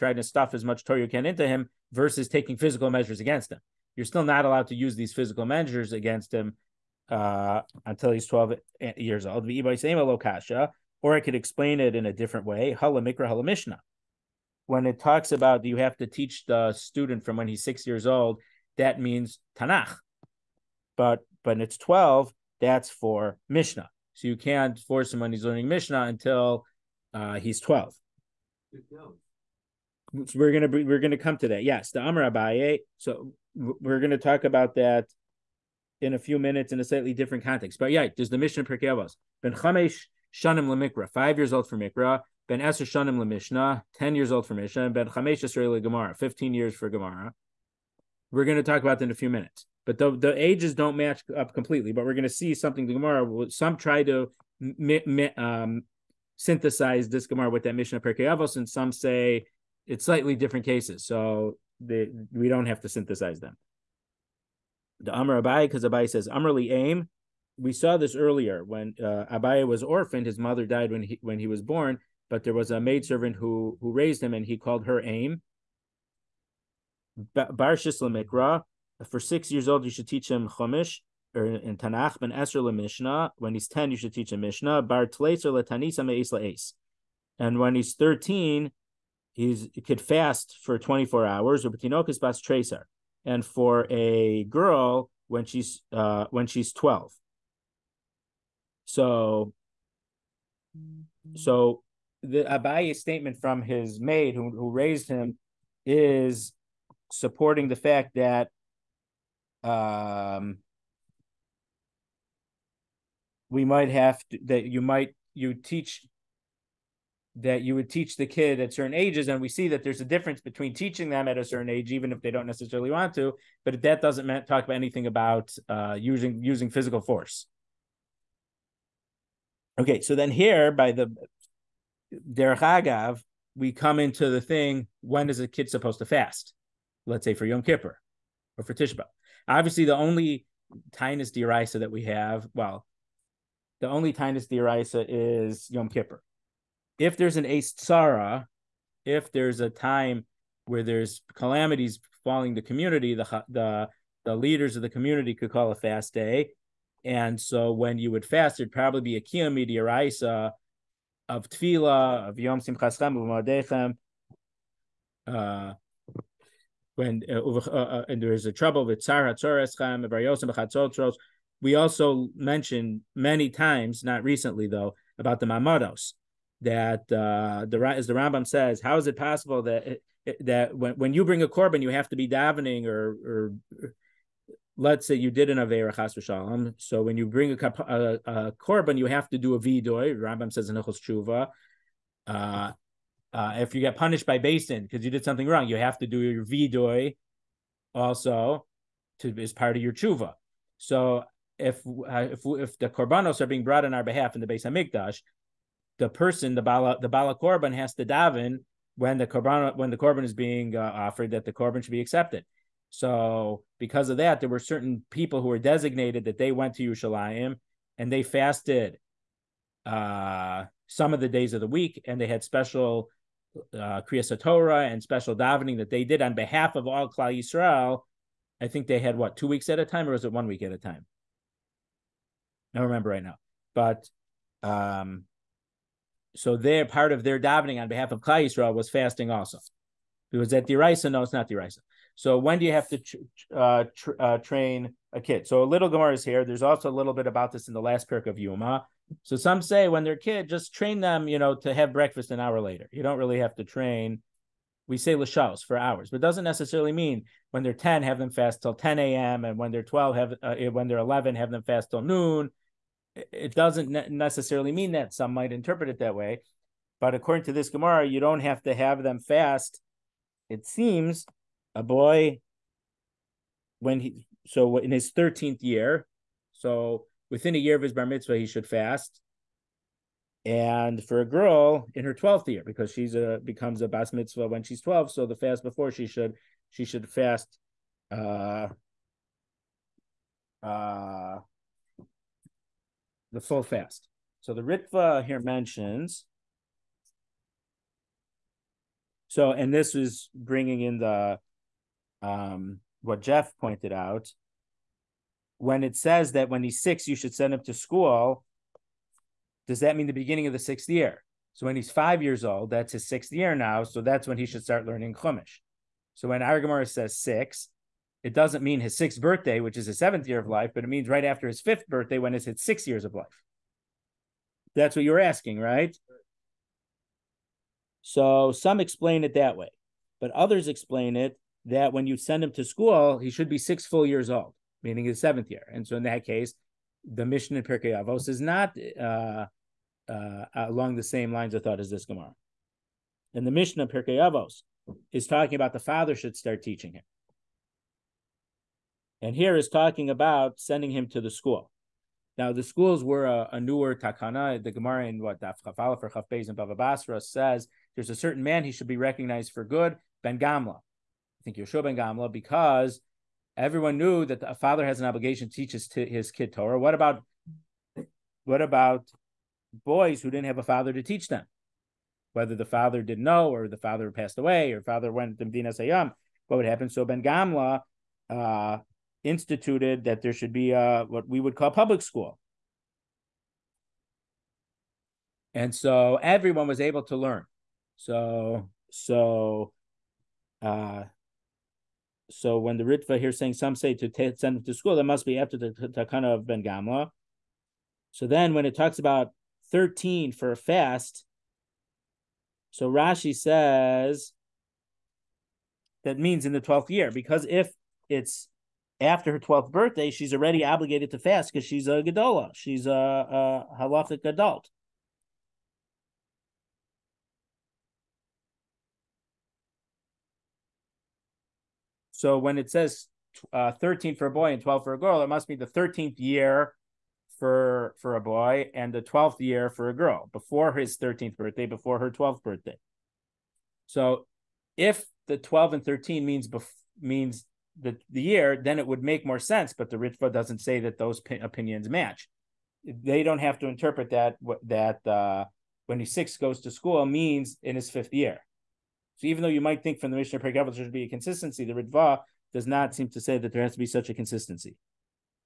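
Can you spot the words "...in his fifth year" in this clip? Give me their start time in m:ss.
7:27.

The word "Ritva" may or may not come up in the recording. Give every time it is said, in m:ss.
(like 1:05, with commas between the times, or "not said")
4:54, 6:32, 7:19, 7:31.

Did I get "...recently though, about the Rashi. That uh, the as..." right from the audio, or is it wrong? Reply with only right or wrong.
wrong.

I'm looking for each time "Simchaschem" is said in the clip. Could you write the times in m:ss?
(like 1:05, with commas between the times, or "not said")
2:42.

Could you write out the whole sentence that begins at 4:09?
So some say when they're kid, just train them, you know, to have breakfast an hour later.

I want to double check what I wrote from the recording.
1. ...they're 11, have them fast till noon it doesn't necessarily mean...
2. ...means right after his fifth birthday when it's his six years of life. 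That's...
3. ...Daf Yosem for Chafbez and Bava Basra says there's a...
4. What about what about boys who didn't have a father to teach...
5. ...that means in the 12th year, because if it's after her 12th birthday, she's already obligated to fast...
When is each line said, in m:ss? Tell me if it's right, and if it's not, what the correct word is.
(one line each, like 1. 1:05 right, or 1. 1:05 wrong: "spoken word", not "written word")
1. 4:20 right
2. 5:20 right
3. 5:55 wrong: "Chafala", not "Yosem"
4. 6:06 right
5. 6:46 right.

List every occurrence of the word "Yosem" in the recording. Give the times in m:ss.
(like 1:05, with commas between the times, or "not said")
2:50.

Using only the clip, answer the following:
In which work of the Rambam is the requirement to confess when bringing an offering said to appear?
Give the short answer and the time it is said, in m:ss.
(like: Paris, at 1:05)
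Hilchos Tshuva, at 3:10.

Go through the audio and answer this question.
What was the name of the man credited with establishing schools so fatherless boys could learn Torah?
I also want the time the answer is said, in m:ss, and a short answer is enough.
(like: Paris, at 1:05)
Yeshua Ben Gamla, at 6:01.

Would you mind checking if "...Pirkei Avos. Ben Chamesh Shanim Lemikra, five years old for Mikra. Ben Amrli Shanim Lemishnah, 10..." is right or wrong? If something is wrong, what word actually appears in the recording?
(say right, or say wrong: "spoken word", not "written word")
wrong: "Esr", not "Amrli".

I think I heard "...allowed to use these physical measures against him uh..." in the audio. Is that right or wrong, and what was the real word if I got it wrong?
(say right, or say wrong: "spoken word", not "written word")
right.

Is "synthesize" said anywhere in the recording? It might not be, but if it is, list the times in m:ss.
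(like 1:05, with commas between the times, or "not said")
0:56, 1:02.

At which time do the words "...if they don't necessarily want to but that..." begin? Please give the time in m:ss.
2:02.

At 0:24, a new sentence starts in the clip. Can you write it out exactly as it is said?
So you can't force him when he's learning Mishnah until uh, he's 12.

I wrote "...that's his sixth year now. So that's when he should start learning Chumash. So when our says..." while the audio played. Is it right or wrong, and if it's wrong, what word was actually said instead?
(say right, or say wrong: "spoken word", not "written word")
right.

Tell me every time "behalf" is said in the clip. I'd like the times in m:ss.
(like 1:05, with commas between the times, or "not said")
3:24, 3:46, 3:57.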